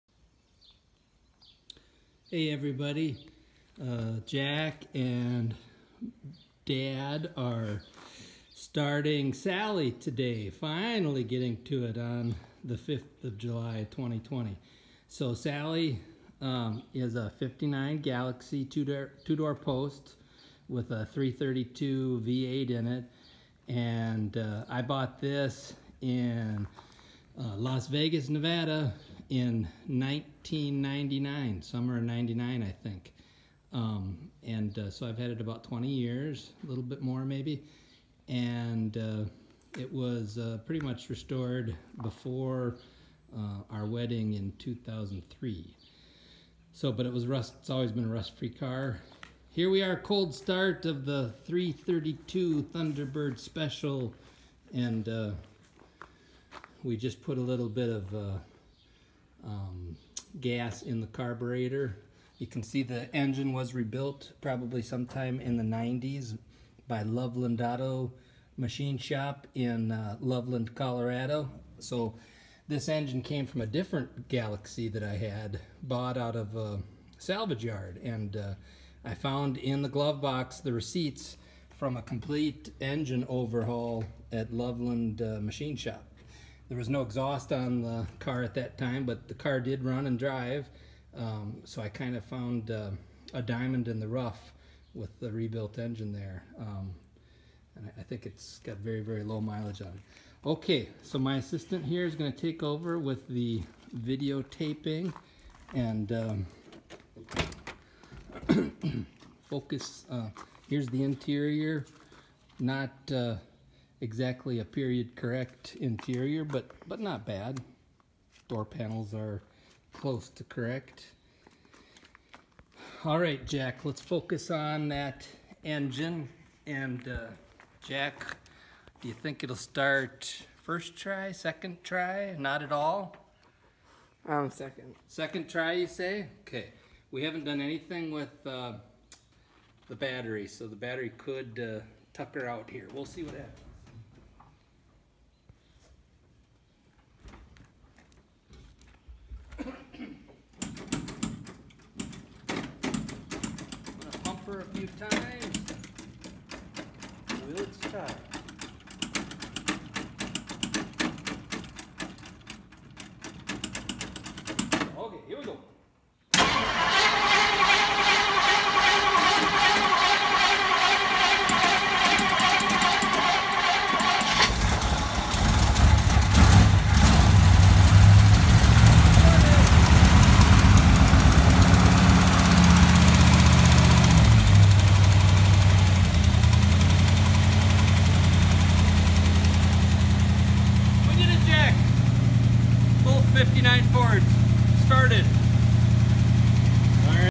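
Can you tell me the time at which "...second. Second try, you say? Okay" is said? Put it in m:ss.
2:14.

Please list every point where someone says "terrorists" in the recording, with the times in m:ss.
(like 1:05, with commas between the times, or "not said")
not said.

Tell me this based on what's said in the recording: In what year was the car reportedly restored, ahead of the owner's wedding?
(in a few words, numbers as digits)
2003.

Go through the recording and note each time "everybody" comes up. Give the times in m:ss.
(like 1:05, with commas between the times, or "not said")
0:02.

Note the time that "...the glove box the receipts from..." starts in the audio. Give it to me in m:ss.
1:19.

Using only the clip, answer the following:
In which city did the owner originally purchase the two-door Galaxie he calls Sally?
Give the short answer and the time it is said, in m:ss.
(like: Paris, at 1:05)
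Las Vegas, at 0:27.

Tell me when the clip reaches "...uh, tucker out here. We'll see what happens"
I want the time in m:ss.
2:21.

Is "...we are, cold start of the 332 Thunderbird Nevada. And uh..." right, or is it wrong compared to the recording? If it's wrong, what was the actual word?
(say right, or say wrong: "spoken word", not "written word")
wrong: "Special", not "Nevada".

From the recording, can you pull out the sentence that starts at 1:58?
Door panels are close to correct.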